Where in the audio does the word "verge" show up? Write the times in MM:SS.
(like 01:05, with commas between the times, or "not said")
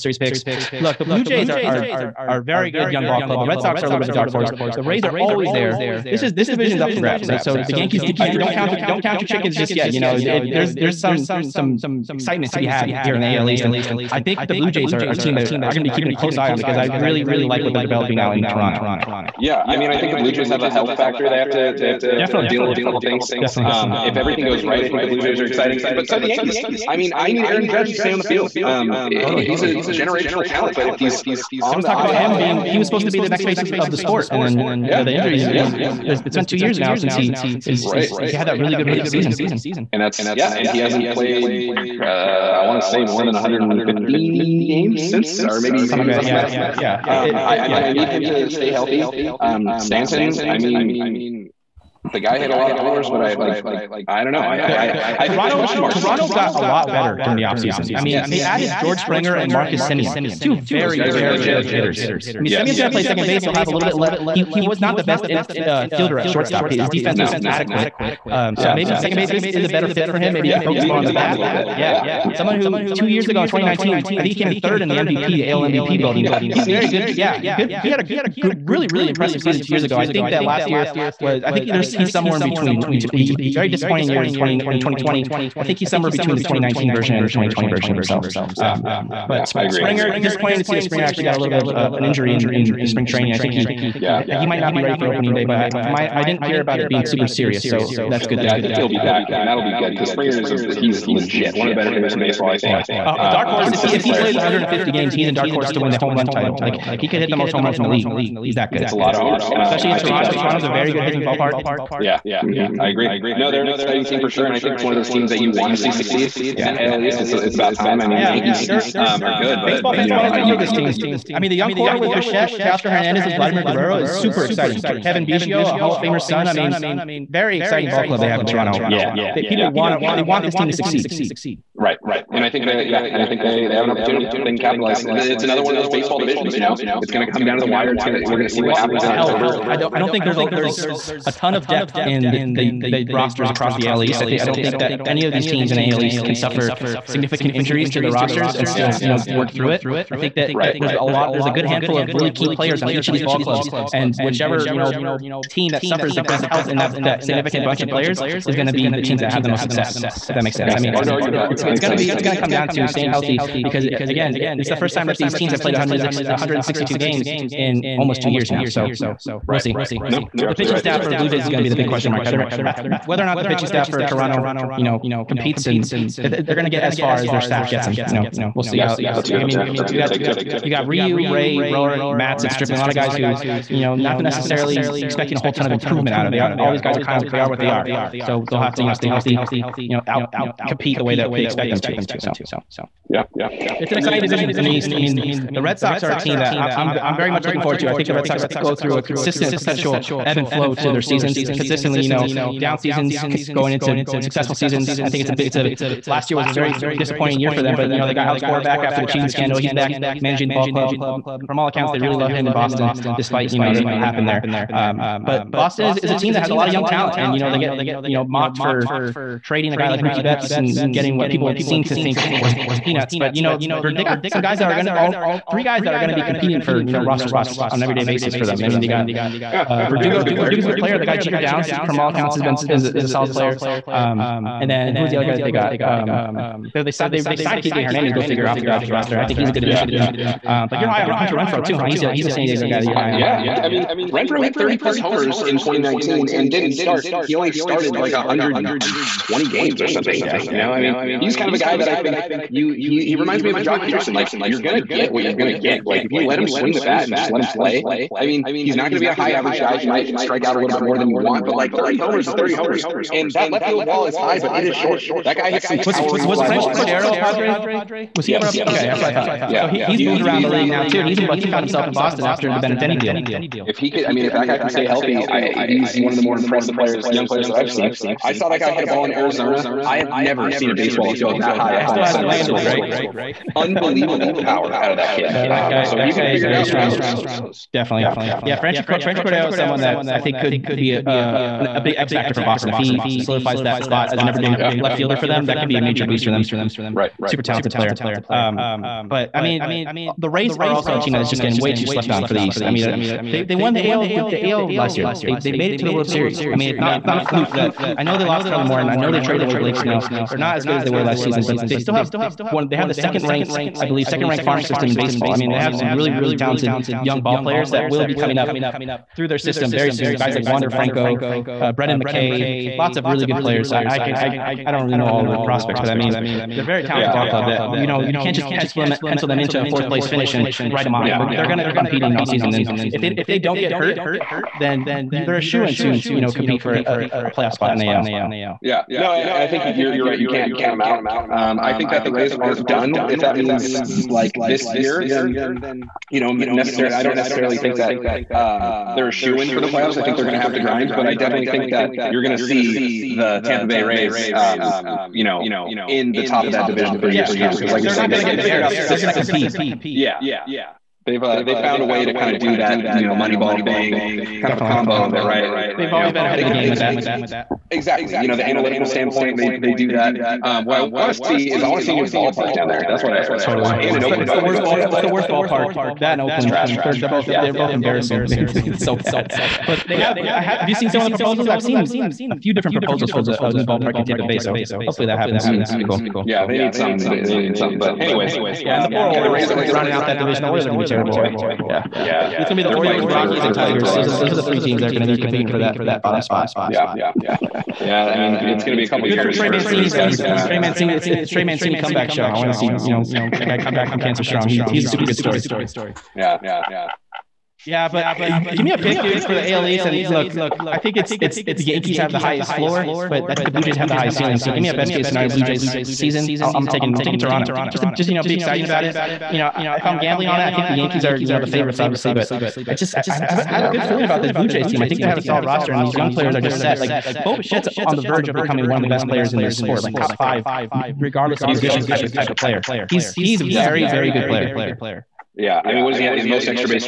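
07:08.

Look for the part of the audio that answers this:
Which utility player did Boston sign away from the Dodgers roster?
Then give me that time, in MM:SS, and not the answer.
03:57.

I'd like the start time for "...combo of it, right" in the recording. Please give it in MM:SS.
06:04.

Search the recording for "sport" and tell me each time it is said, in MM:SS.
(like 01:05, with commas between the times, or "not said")
00:33, 07:09.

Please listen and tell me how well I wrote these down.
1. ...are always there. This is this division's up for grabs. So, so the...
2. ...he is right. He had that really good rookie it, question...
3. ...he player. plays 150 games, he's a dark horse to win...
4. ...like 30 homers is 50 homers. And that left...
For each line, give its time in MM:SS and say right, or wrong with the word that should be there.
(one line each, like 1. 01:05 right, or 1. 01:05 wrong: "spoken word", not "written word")
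1. 00:05 right
2. 00:37 wrong: "season", not "question"
3. 01:44 right
4. 04:21 wrong: "30", not "50".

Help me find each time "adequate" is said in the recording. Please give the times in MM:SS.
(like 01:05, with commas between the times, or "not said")
01:07.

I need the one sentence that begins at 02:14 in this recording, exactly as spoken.
they can capitalize, it's another one of those baseball divisions, you know, it's going to come down to the wire.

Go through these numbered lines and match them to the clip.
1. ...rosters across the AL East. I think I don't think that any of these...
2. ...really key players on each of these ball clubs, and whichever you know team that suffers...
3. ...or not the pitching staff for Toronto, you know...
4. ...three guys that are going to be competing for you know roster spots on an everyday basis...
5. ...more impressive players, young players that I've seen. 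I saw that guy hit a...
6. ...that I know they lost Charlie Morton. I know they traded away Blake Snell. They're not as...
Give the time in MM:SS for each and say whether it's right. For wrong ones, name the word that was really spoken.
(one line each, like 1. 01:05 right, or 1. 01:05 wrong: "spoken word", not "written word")
1. 02:23 right
2. 02:32 right
3. 02:53 right
4. 03:45 right
5. 04:36 right
6. 05:07 right.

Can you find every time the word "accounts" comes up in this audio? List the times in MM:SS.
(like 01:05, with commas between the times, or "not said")
03:31, 03:52.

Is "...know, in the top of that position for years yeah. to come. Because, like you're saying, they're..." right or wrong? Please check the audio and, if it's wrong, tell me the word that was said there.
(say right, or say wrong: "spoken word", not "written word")
wrong: "division", not "position".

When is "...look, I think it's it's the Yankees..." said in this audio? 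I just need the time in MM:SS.
06:50.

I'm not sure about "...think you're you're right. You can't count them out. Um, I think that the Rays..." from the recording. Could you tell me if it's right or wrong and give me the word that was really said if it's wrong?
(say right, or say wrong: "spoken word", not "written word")
right.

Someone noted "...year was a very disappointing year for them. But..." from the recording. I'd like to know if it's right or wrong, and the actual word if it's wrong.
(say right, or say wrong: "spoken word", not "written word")
right.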